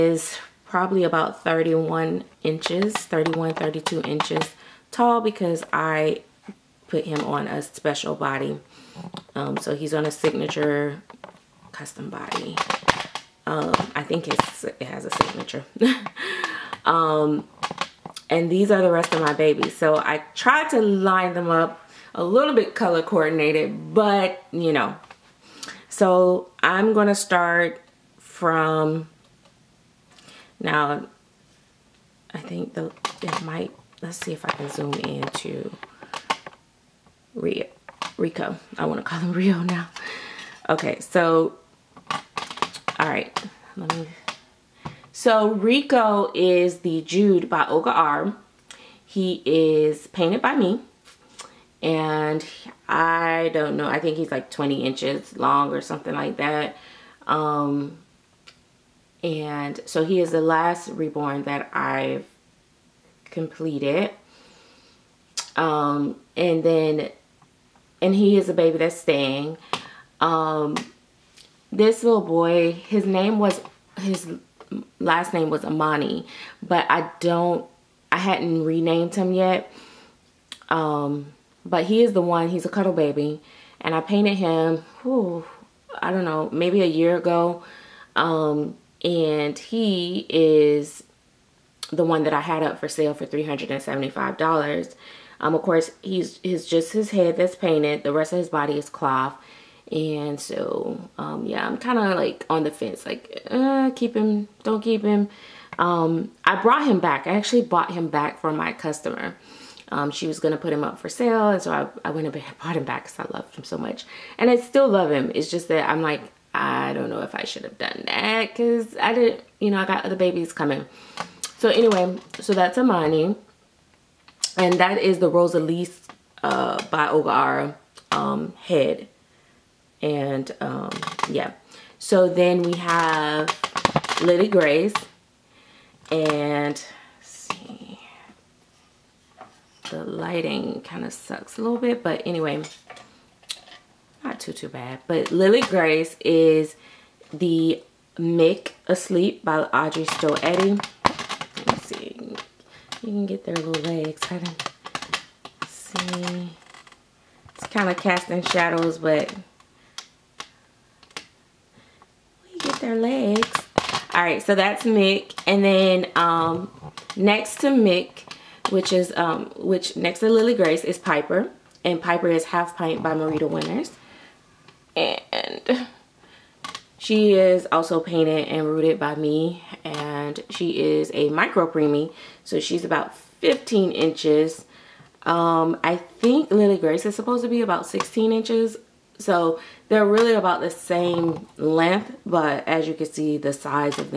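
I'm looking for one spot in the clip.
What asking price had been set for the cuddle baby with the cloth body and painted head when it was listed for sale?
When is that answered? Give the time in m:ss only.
1:33.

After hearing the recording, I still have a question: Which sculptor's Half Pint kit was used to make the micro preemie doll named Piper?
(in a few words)
Marita Winters.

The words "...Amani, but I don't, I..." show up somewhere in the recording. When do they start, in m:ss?
1:15.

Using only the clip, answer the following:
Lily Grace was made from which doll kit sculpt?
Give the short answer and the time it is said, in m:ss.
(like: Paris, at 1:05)
Mick Asleep, at 2:28.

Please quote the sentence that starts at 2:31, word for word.
let see you can get their little legs kind of see it's kind of casting shadows but their legs.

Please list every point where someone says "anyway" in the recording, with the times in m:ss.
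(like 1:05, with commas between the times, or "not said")
2:01, 2:22.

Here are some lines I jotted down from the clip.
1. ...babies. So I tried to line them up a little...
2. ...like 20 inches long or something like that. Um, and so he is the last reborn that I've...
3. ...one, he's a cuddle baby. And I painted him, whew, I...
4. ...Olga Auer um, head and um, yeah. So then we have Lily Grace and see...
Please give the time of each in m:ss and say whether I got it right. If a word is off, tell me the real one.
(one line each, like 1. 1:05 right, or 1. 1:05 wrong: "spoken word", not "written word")
1. 0:19 right
2. 0:54 right
3. 1:22 right
4. 2:07 right.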